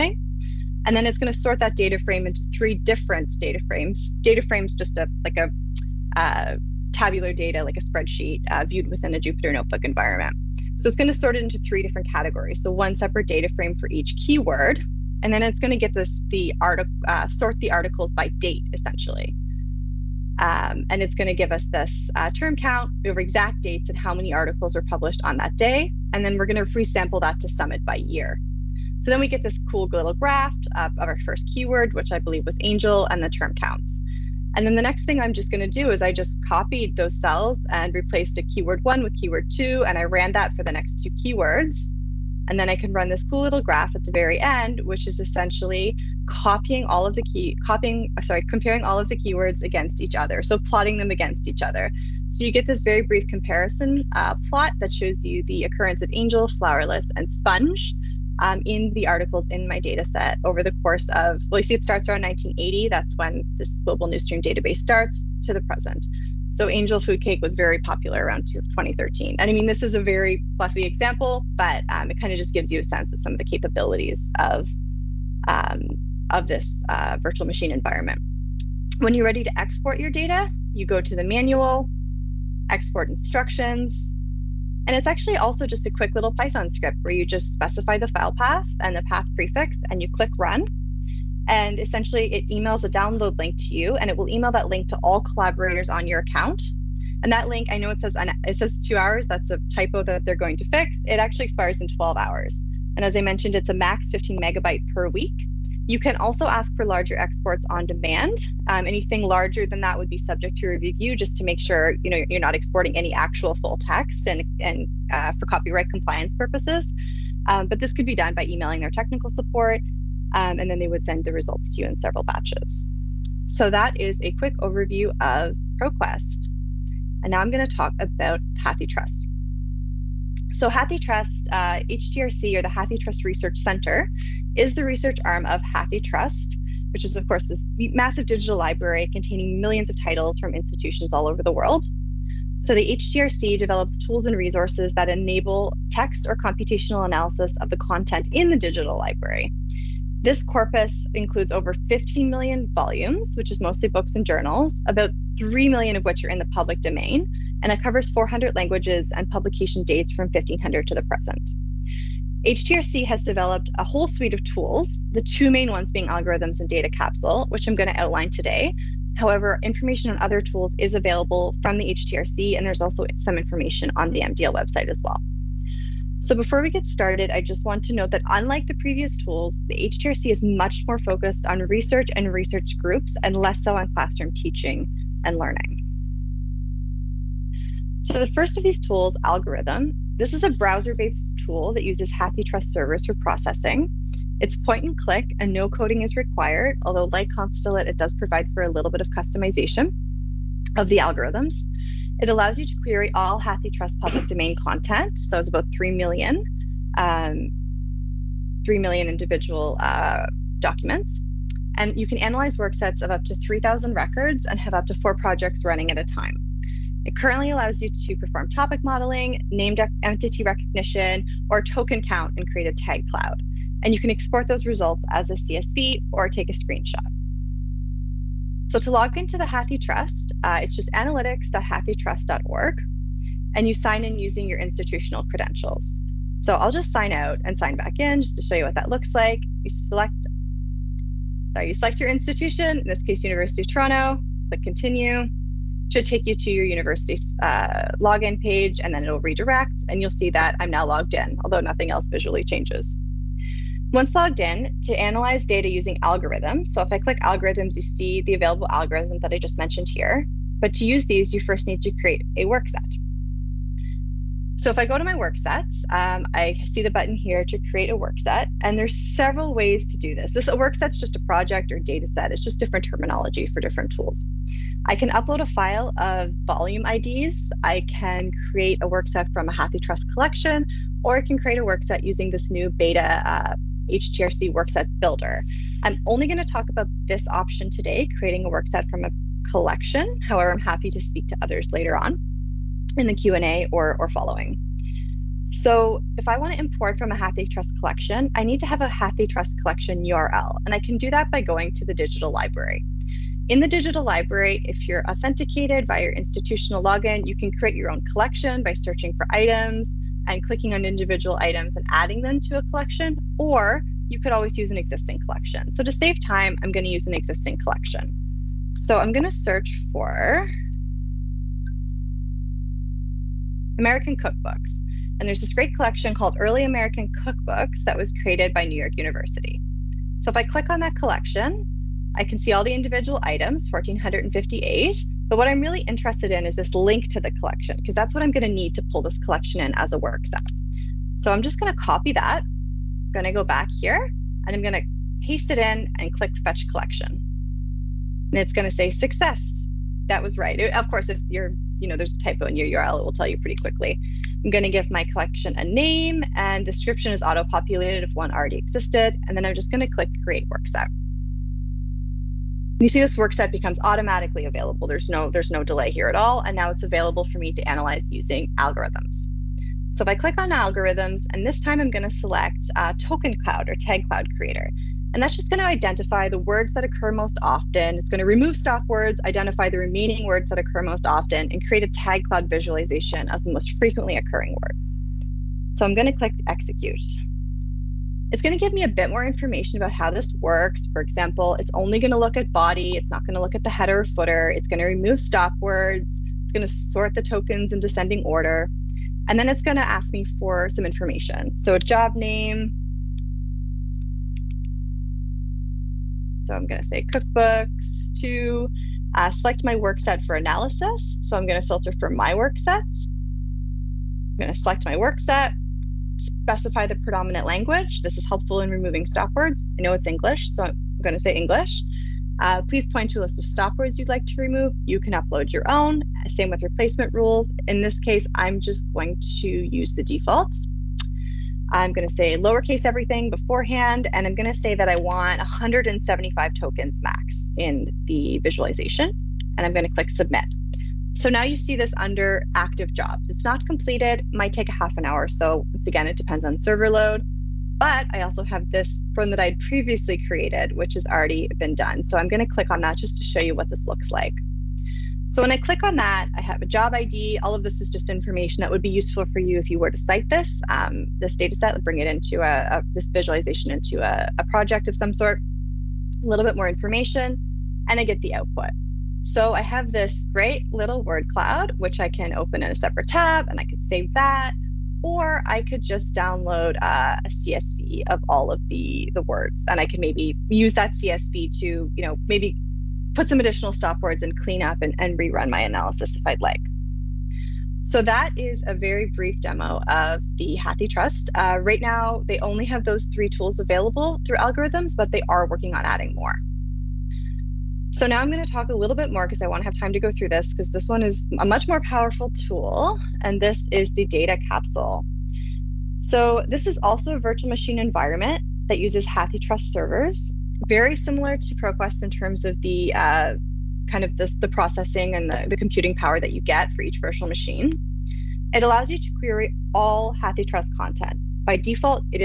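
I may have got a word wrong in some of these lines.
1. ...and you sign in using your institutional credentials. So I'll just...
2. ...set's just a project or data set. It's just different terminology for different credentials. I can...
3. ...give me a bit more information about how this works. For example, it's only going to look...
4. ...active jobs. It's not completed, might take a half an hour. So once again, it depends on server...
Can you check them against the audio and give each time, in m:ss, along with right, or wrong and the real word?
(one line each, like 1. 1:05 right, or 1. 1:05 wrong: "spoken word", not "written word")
1. 3:53 right
2. 4:30 wrong: "tools", not "credentials"
3. 6:28 right
4. 7:22 right.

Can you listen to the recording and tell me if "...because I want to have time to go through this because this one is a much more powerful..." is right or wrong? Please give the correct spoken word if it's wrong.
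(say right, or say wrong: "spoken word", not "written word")
right.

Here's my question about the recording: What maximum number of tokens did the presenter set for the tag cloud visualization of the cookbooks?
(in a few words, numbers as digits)
175.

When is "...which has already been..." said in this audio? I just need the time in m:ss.
7:30.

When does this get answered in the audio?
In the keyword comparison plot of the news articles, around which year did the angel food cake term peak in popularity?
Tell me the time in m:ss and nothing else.
1:08.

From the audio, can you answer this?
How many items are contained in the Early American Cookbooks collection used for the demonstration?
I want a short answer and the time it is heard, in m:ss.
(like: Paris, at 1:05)
1458, at 5:33.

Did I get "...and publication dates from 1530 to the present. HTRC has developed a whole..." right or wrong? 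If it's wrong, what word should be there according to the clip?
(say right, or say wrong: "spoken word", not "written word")
wrong: "1500", not "1530".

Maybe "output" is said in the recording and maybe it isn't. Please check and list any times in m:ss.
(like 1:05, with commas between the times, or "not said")
7:48.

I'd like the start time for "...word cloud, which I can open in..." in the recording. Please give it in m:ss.
7:51.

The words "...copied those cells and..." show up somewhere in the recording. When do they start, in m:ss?
0:36.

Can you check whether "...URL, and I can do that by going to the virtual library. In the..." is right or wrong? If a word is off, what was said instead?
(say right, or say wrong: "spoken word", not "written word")
wrong: "digital", not "virtual".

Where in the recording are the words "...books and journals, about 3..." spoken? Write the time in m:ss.
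2:33.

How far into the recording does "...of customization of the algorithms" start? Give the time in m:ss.
3:18.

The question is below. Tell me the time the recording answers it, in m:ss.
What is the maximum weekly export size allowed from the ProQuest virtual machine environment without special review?
1:44.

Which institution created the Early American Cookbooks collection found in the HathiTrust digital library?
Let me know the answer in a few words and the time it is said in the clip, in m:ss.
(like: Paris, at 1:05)
New York University, at 5:28.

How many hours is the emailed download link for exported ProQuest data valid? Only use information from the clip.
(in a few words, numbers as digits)
12 hours.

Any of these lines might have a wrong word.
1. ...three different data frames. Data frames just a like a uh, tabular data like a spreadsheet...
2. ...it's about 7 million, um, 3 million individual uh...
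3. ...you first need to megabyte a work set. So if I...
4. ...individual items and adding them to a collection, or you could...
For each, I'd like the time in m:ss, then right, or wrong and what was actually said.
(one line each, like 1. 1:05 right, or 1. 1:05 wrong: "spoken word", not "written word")
1. 0:02 right
2. 3:25 wrong: "3", not "7"
3. 4:21 wrong: "create", not "megabyte"
4. 5:10 right.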